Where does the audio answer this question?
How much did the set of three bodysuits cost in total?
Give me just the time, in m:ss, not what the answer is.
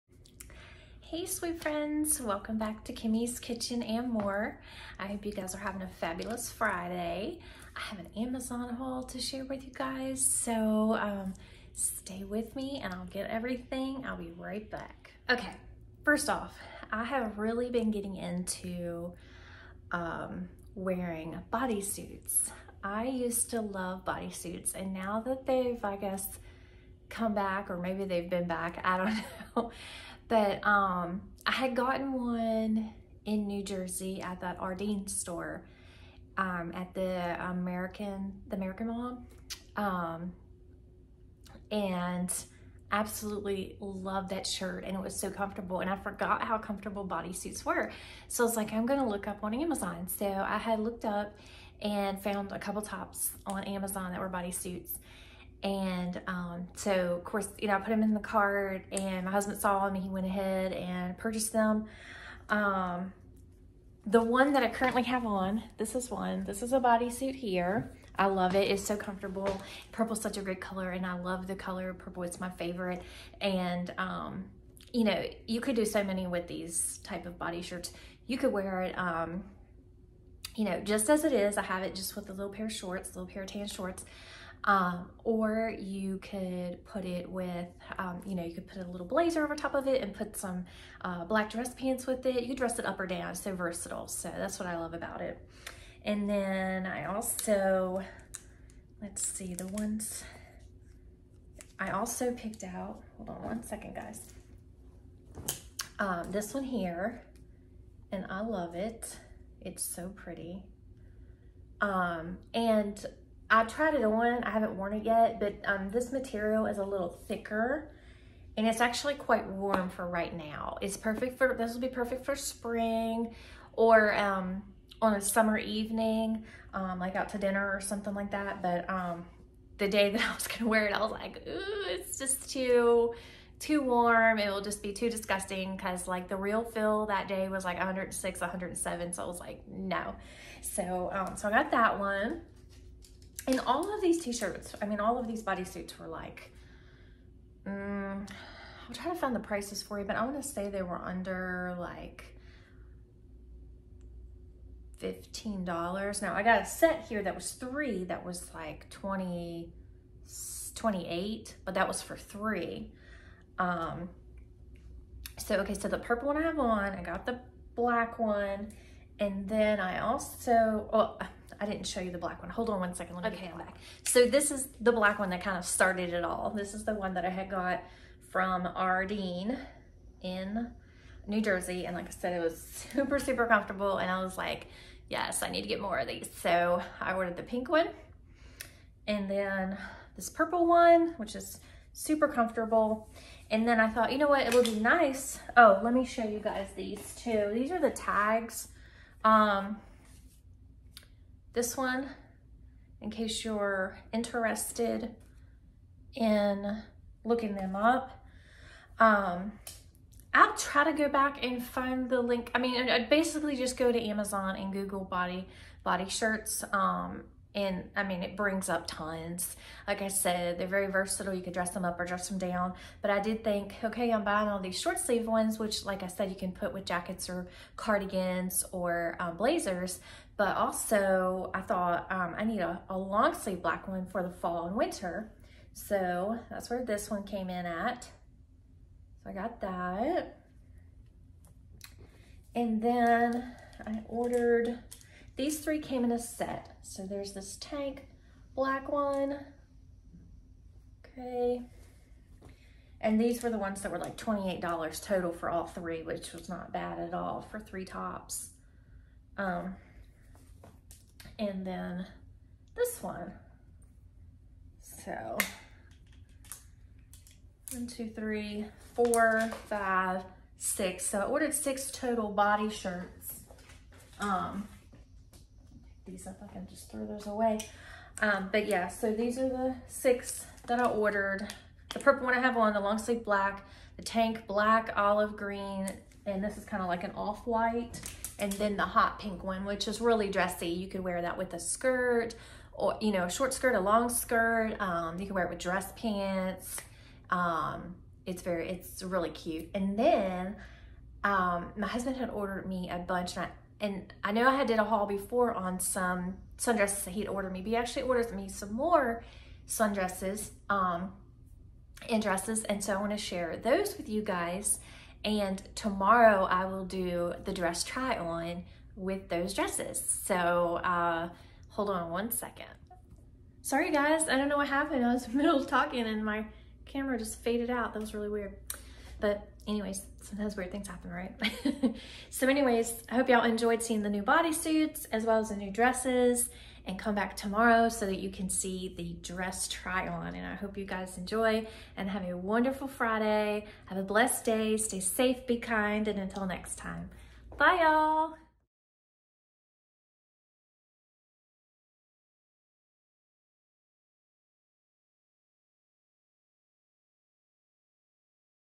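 4:14.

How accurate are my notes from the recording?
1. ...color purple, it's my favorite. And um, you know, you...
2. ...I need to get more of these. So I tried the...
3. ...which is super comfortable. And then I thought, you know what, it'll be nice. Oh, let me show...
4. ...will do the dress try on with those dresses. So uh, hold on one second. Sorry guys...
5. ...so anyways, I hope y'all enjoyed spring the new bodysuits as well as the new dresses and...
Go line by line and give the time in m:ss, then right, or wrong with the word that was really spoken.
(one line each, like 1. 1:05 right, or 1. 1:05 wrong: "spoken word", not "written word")
1. 1:11 right
2. 3:05 wrong: "ordered", not "tried"
3. 3:11 right
4. 5:16 right
5. 5:32 wrong: "seeing", not "spring".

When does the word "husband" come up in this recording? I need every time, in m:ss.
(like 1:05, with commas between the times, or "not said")
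0:59, 5:01.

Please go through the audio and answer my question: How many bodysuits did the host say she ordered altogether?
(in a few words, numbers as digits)
6.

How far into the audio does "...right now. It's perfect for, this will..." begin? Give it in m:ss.
2:00.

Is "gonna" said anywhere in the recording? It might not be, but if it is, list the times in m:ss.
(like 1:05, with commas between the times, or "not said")
0:48, 2:10.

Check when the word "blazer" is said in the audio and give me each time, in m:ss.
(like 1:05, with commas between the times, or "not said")
1:29, 3:49.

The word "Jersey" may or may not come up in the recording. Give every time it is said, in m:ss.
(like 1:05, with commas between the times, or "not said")
0:33, 3:01.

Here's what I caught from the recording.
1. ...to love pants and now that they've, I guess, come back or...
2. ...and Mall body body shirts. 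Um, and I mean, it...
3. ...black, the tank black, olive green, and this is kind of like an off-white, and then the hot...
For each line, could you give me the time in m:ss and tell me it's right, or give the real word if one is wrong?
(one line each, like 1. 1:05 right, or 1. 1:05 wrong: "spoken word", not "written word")
1. 0:23 wrong: "bodysuits", not "pants"
2. 3:34 wrong: "Google", not "Mall"
3. 4:43 right.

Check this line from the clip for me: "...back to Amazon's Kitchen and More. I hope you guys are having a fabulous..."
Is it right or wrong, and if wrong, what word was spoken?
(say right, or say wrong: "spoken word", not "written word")
wrong: "Kimmie", not "Amazon".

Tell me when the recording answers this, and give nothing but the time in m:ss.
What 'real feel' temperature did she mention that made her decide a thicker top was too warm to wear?
2:17.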